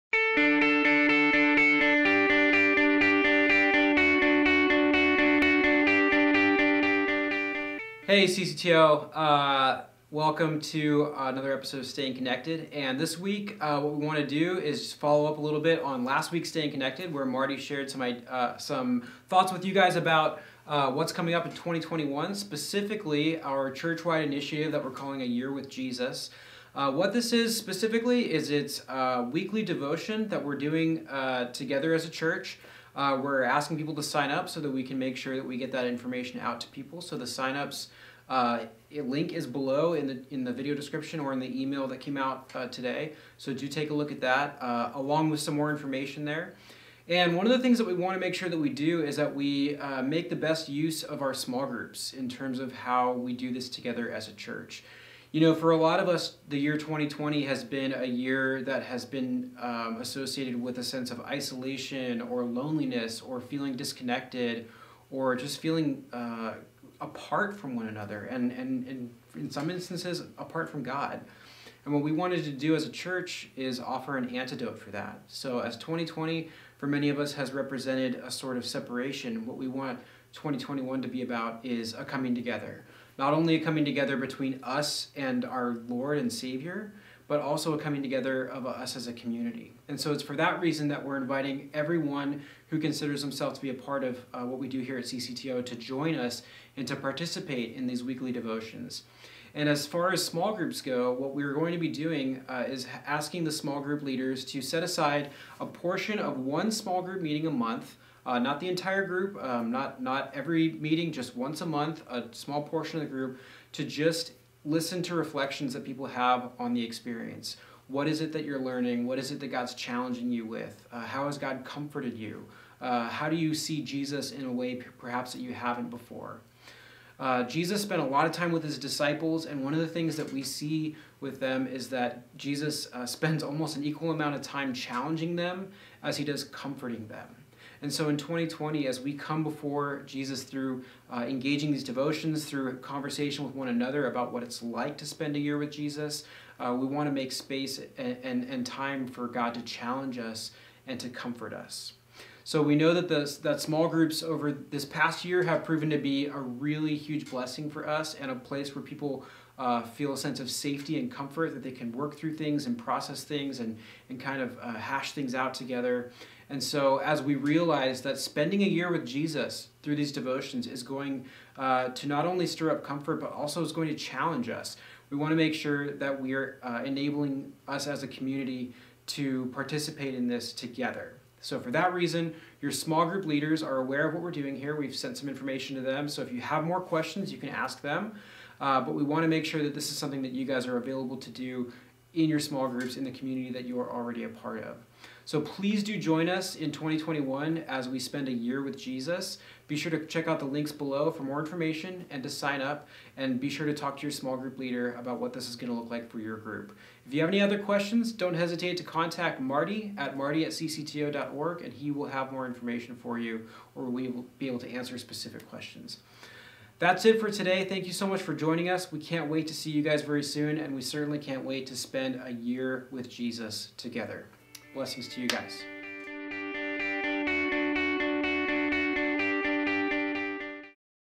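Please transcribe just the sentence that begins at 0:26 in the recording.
Uh, what this is specifically is it's a weekly devotion that we're doing uh, together as a church.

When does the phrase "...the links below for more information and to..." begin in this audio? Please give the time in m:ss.
3:20.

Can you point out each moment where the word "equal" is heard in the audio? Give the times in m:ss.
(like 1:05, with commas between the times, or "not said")
2:13.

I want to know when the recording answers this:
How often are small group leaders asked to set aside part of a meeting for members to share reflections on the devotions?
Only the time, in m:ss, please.
1:51.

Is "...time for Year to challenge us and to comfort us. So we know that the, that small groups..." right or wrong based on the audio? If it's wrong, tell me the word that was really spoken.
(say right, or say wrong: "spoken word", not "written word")
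wrong: "God", not "Year".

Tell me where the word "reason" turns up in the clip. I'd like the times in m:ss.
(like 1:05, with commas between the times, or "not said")
1:30, 3:01.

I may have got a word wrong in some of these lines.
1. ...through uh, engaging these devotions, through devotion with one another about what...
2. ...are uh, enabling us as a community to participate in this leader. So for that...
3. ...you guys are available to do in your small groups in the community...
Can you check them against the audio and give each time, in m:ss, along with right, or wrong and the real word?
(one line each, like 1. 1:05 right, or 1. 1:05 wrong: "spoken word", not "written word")
1. 2:20 wrong: "conversation", not "devotion"
2. 2:56 wrong: "together", not "leader"
3. 3:10 right.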